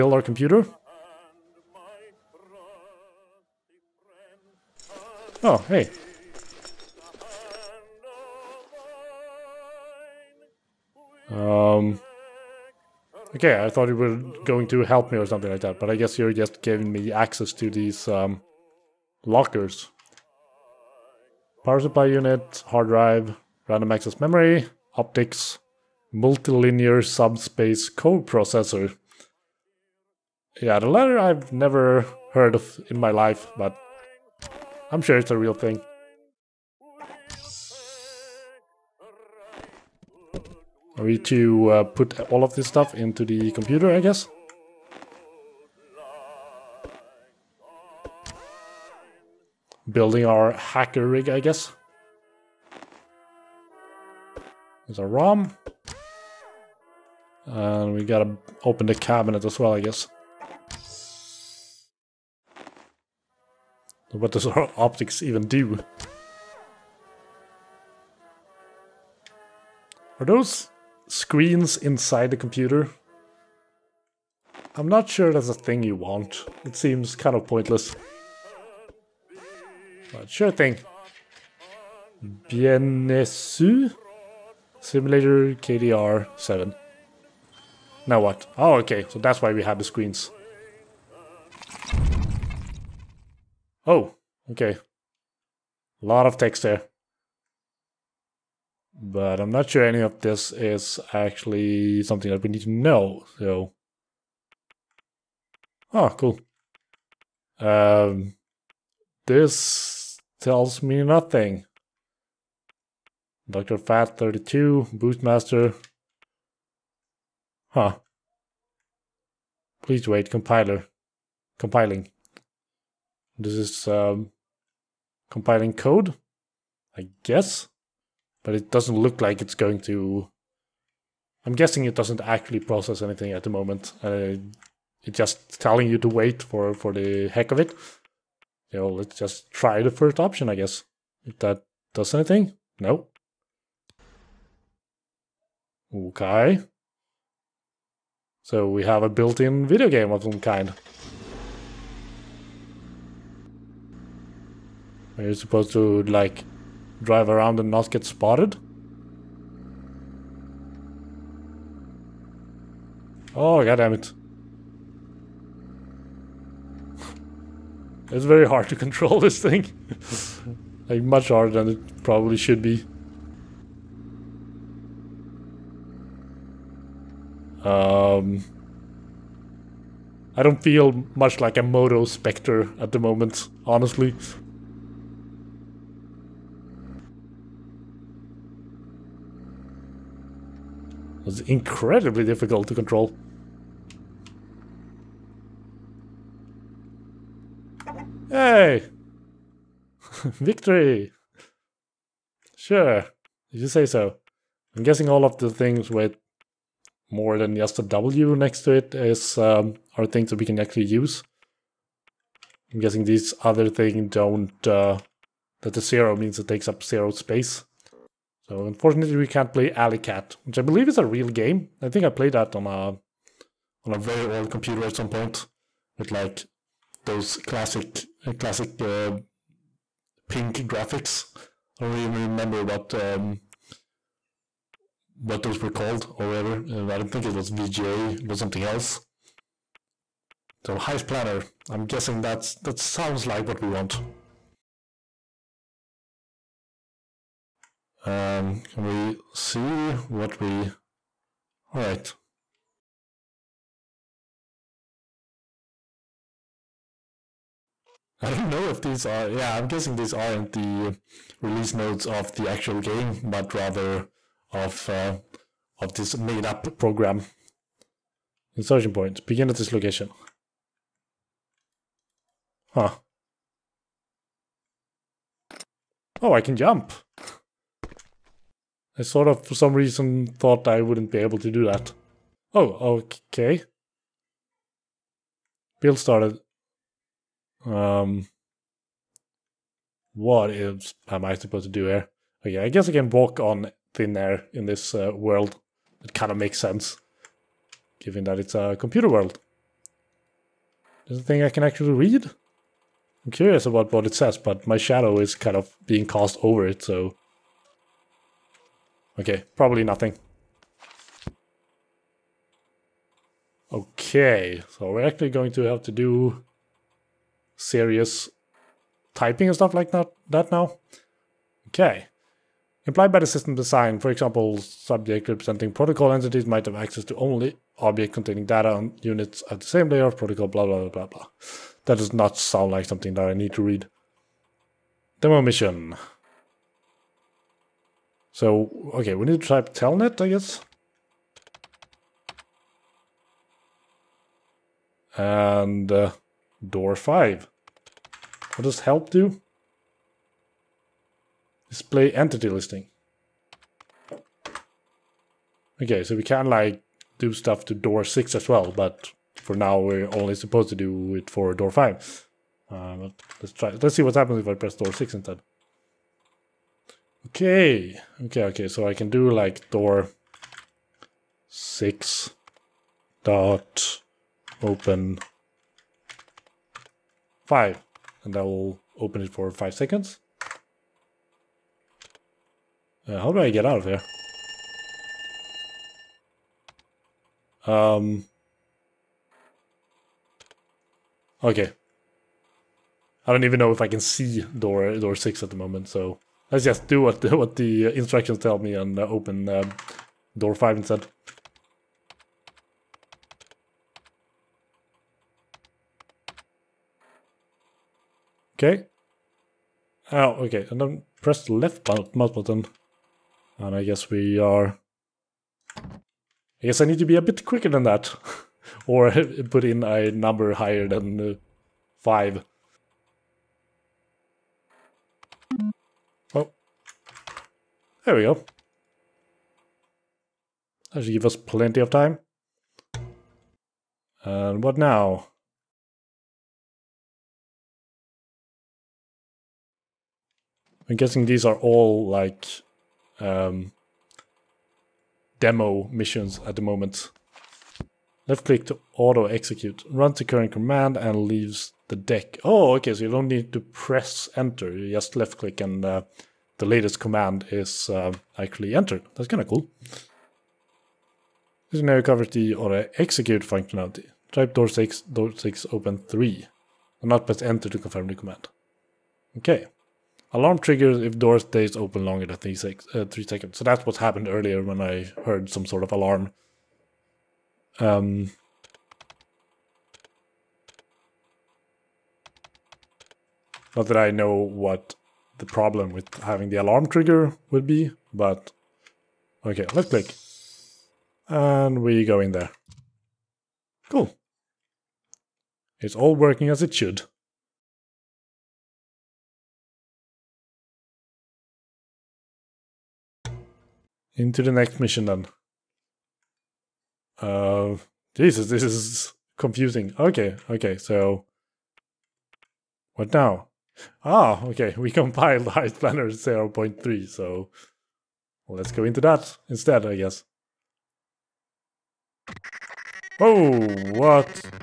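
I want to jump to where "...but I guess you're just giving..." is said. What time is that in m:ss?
0:15.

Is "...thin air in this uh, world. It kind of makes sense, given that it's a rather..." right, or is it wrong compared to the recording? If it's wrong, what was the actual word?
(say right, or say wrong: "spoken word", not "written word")
wrong: "computer", not "rather".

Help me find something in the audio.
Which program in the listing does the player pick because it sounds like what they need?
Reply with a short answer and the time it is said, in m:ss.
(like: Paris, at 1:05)
Heist Planner, at 4:00.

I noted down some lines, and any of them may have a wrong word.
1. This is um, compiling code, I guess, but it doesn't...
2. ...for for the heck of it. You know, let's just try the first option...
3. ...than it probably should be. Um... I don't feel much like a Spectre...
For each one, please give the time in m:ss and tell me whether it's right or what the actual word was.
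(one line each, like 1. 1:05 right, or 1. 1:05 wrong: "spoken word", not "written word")
1. 2:03 right
2. 2:16 right
3. 2:51 wrong: "Moto", not "Spectre".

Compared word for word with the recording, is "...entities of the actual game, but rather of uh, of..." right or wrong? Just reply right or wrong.
wrong.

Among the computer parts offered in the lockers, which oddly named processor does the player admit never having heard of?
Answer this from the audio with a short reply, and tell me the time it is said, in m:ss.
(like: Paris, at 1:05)
multilinear subspace processor, at 0:26.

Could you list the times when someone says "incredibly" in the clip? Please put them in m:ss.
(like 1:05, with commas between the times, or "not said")
3:11.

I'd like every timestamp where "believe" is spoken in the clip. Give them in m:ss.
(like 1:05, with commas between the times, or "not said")
3:40.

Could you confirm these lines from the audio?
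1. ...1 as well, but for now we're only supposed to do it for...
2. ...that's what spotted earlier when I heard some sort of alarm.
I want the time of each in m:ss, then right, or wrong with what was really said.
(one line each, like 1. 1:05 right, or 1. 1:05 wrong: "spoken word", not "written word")
1. 5:58 wrong: "6", not "1"
2. 7:53 wrong: "happened", not "spotted".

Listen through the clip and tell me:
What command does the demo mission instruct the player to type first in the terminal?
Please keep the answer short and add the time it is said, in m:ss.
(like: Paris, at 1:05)
telnet, at 5:39.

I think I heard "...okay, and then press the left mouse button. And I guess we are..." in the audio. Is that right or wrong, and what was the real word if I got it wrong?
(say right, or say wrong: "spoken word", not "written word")
right.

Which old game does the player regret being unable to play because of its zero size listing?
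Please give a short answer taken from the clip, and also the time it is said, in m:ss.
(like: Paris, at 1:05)
Alley Cat, at 3:39.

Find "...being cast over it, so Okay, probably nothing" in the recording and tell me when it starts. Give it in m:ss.
5:05.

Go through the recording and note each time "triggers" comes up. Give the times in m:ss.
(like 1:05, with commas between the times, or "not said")
7:50, 8:06.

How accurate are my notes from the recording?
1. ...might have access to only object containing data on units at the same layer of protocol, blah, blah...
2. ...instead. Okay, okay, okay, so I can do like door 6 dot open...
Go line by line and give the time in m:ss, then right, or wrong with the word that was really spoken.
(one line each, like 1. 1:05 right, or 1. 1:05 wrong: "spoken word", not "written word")
1. 5:26 right
2. 6:05 right.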